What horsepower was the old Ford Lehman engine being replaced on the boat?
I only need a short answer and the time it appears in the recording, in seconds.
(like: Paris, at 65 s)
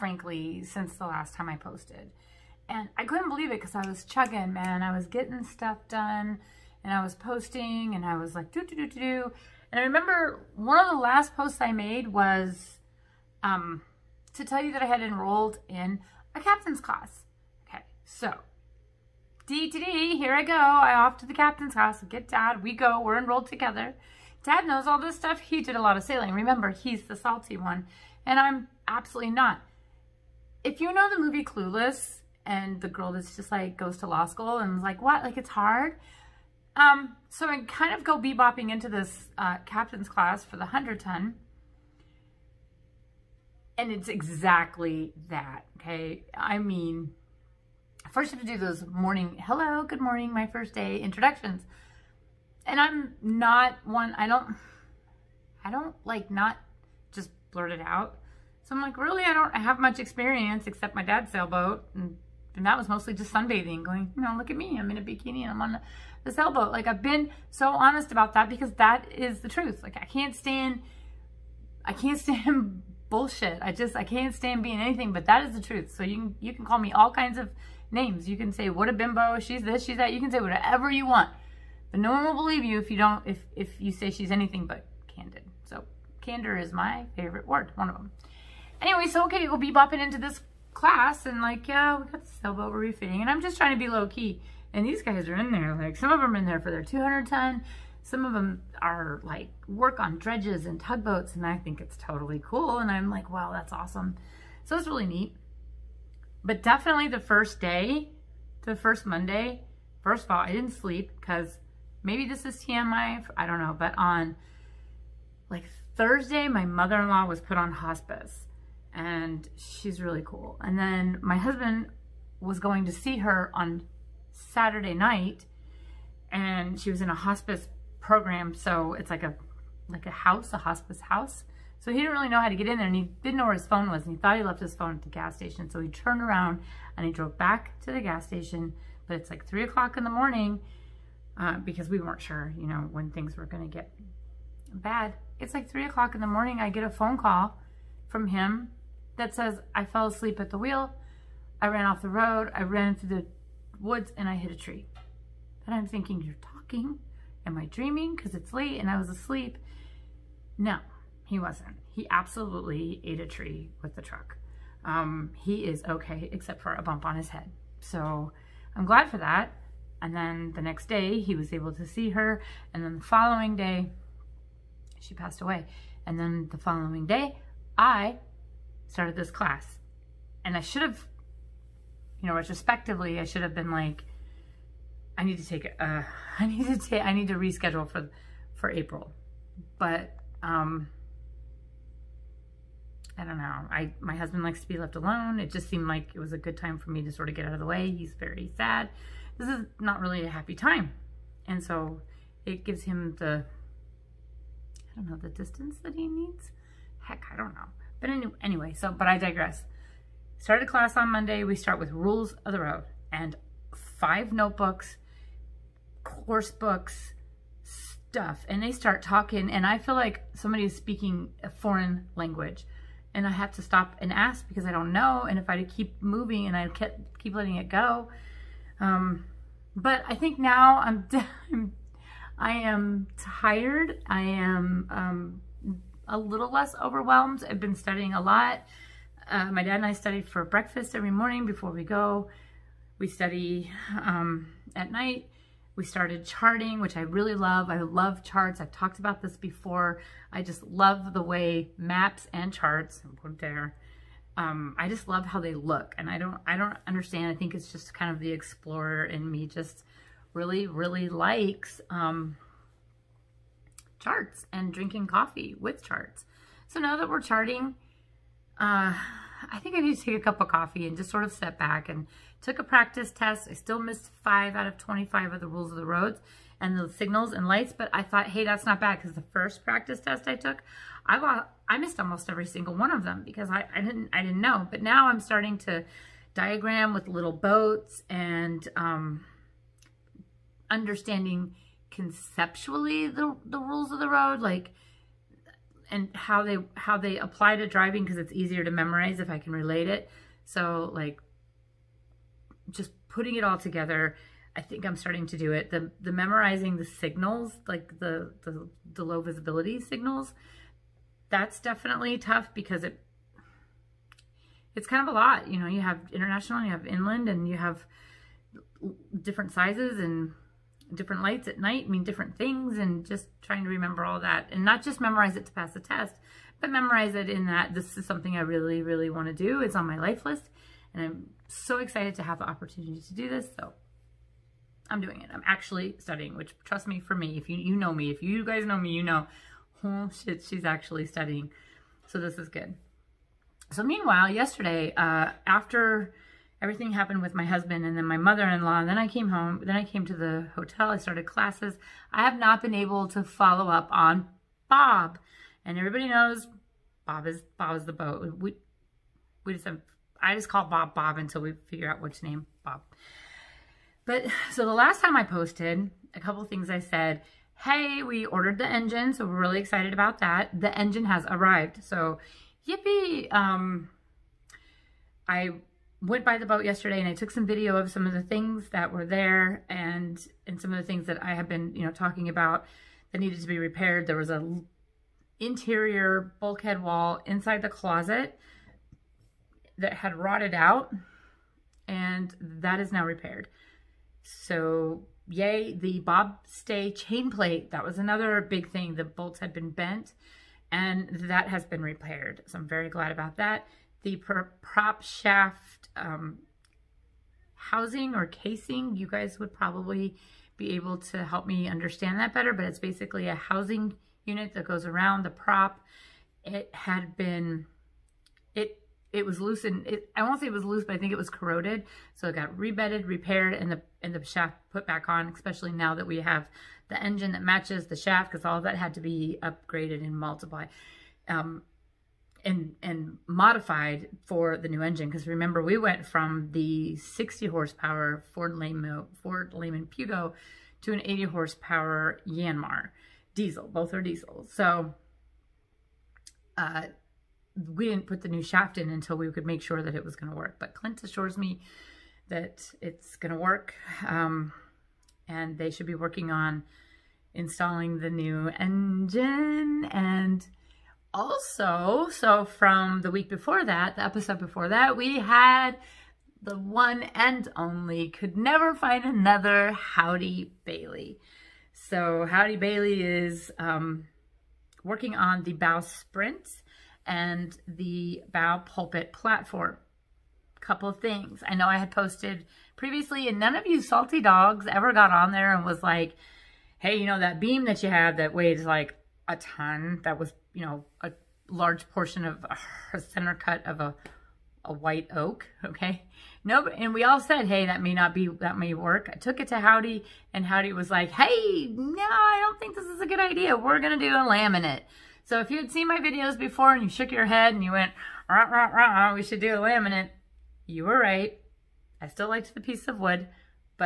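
60, at 436 s.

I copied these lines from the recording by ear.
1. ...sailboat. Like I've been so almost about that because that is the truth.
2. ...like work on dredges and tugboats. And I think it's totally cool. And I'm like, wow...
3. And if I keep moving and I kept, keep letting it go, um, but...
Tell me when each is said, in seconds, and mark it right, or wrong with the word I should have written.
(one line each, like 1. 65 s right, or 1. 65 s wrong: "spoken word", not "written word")
1. 66 s wrong: "honest", not "almost"
2. 99 s right
3. 225 s right.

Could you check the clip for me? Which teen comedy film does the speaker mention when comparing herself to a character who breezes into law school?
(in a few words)
Clueless.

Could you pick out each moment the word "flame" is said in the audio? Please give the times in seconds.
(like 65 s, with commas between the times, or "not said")
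not said.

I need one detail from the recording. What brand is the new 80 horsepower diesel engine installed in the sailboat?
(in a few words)
Yanmar.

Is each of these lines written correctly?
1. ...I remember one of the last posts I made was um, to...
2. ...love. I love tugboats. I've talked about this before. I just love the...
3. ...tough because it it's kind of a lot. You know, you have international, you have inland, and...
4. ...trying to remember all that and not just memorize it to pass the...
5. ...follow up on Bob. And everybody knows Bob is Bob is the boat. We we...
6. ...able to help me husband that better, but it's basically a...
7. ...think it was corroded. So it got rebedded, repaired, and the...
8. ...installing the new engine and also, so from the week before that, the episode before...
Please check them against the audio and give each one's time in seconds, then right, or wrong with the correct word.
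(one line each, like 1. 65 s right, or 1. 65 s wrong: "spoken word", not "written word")
1. 9 s right
2. 247 s wrong: "charts", not "tugboats"
3. 312 s right
4. 323 s right
5. 353 s right
6. 410 s wrong: "understand", not "husband"
7. 420 s right
8. 457 s right.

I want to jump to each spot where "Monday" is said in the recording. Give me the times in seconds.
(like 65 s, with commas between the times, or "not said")
109 s, 211 s.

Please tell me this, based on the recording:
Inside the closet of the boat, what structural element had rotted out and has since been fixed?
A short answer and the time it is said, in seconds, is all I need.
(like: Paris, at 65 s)
interior bulkhead wall, at 385 s.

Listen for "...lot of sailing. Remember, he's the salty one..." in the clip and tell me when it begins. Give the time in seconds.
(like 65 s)
25 s.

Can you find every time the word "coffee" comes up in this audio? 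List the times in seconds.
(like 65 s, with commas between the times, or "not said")
265 s, 270 s.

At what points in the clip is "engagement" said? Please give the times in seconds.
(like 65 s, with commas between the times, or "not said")
not said.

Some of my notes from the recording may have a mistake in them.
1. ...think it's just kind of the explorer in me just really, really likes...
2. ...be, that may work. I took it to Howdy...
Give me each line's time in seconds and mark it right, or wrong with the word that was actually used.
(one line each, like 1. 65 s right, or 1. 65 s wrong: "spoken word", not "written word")
1. 257 s right
2. 498 s right.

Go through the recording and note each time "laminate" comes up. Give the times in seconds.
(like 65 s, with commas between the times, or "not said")
504 s, 509 s.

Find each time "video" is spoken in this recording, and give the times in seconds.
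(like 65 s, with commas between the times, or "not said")
377 s, 505 s.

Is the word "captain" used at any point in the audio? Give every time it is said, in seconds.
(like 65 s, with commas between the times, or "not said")
16 s, 21 s, 39 s.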